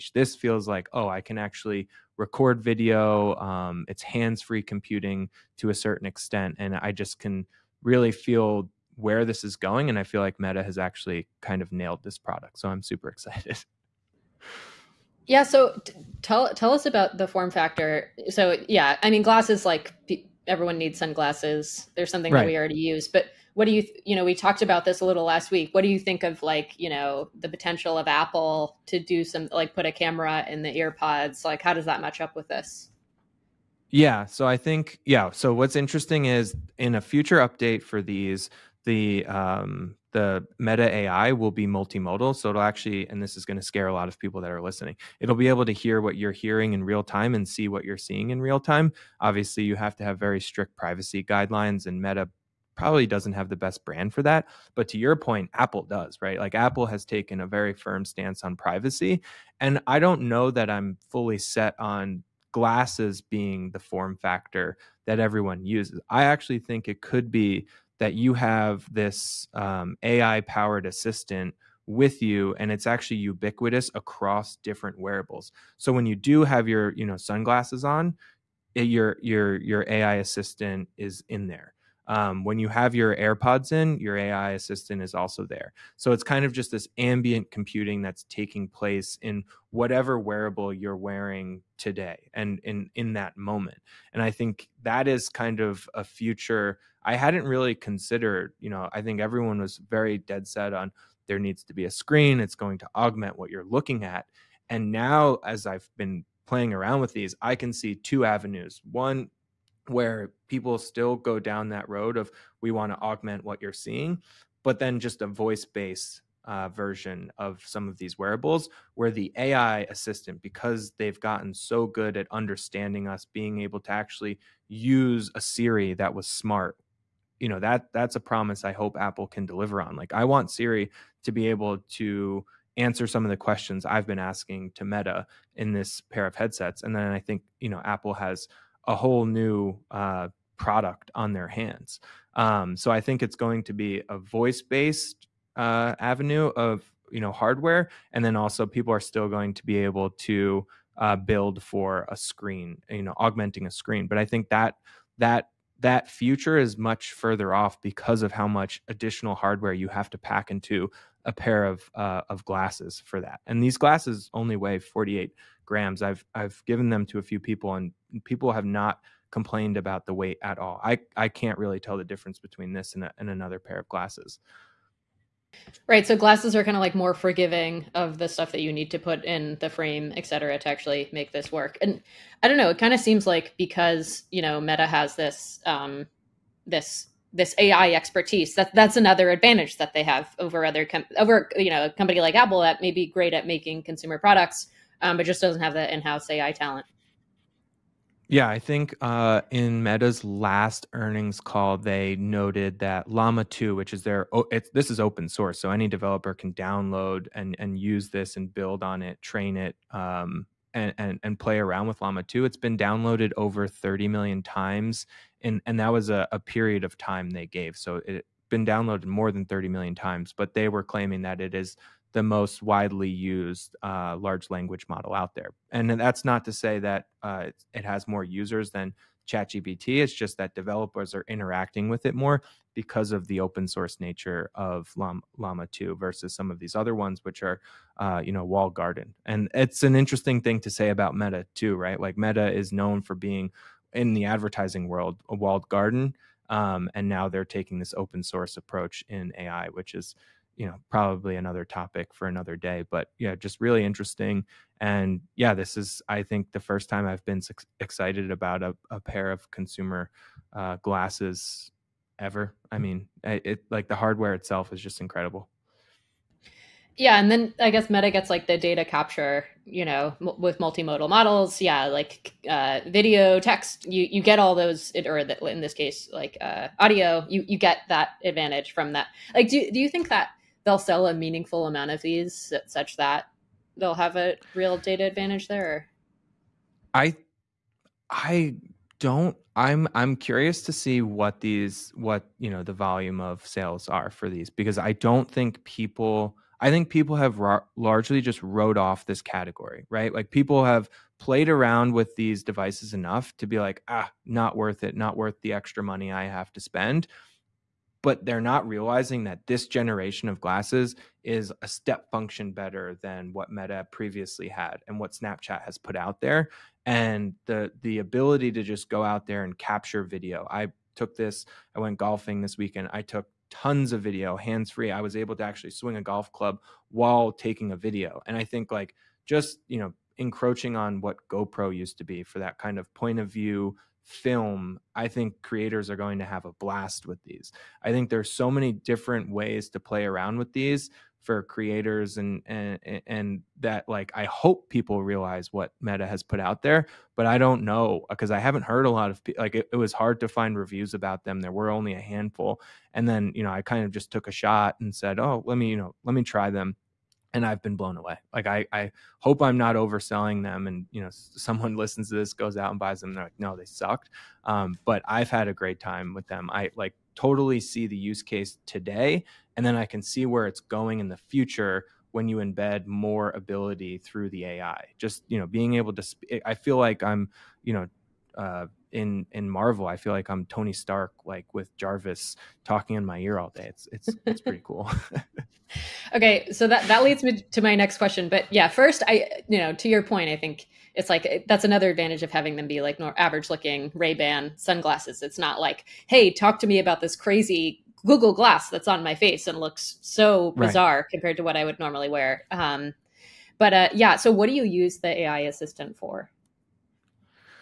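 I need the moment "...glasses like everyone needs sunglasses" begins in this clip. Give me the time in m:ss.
0:19.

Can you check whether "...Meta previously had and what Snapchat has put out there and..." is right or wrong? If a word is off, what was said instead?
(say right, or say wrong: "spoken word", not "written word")
right.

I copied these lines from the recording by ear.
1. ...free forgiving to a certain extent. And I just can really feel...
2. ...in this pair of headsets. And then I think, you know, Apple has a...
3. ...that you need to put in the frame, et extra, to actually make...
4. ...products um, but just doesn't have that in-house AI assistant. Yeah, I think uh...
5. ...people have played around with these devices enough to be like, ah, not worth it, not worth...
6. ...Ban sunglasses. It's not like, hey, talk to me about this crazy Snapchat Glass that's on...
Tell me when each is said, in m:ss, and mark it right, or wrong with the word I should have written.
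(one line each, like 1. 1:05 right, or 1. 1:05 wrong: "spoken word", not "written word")
1. 0:04 wrong: "computing", not "forgiving"
2. 2:15 right
3. 2:58 wrong: "cetera", not "extra"
4. 3:14 wrong: "talent", not "assistant"
5. 5:00 right
6. 6:34 wrong: "Google", not "Snapchat".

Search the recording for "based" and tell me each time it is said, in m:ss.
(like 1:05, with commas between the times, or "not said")
1:55, 2:24.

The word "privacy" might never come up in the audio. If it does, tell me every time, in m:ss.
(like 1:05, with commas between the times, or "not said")
0:50, 0:58.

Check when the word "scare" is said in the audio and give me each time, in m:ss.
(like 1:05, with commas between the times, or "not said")
0:43.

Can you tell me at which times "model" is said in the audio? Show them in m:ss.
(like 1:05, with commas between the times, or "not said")
3:44, 4:31.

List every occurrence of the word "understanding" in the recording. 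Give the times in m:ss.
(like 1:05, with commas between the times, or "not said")
2:02.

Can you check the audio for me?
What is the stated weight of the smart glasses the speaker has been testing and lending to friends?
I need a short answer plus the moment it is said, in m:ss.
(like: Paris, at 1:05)
48 grams, at 2:44.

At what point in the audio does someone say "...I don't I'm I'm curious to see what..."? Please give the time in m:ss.
4:48.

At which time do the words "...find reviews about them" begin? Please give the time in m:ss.
5:50.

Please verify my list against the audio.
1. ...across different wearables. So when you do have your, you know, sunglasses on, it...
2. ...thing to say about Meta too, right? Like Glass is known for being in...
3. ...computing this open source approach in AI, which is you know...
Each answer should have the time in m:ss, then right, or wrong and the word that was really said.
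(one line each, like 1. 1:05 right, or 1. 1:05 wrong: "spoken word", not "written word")
1. 1:13 right
2. 4:00 wrong: "Meta", not "Glass"
3. 4:07 wrong: "taking", not "computing".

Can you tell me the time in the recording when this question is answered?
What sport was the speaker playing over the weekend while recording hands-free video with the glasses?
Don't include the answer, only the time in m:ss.
5:21.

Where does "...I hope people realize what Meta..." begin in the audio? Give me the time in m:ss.
5:44.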